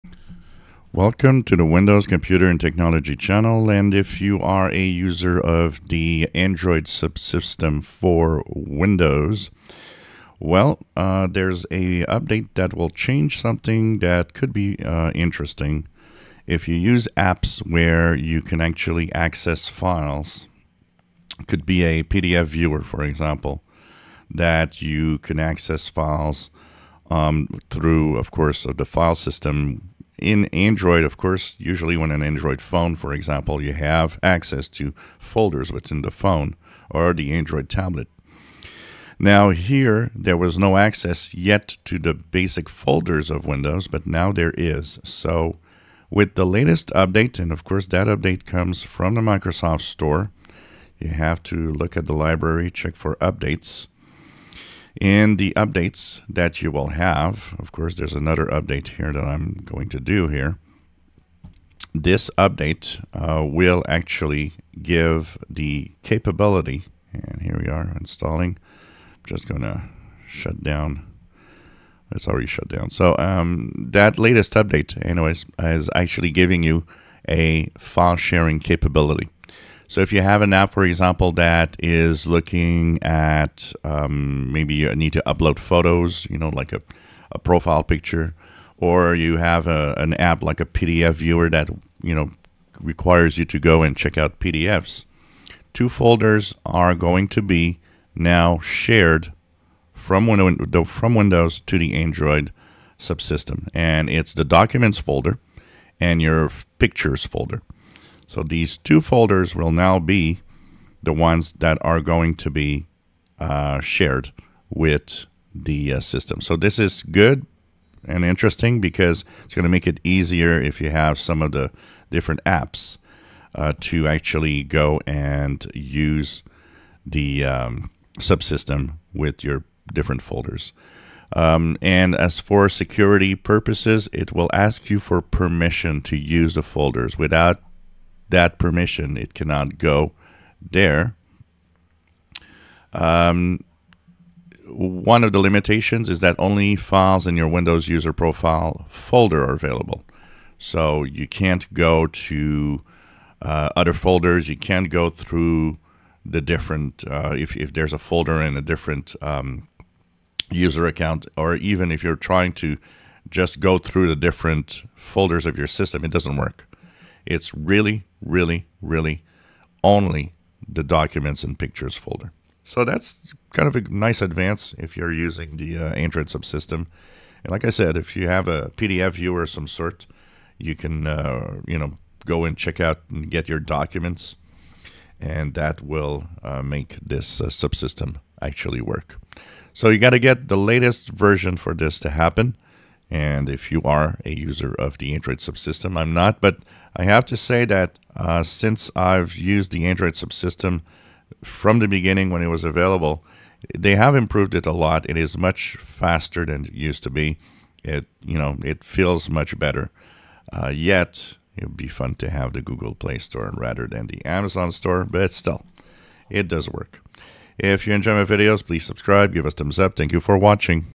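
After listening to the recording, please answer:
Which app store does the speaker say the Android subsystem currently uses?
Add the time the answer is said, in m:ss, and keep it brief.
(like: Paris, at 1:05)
Amazon Store, at 3:34.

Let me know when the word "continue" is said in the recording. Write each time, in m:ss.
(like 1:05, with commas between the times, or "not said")
not said.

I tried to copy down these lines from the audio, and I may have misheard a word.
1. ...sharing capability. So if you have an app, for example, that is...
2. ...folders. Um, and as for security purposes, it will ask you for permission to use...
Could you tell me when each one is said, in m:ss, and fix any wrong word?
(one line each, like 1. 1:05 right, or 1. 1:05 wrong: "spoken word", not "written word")
1. 1:18 right
2. 2:10 right.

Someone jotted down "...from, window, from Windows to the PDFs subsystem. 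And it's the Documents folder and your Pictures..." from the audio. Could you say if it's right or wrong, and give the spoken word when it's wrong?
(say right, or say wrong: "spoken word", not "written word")
wrong: "Android", not "PDFs".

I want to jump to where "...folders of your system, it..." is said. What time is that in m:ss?
2:44.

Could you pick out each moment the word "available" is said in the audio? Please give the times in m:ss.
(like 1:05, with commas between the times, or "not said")
2:29, 3:22.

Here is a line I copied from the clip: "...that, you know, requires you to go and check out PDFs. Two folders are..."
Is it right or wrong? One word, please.
right.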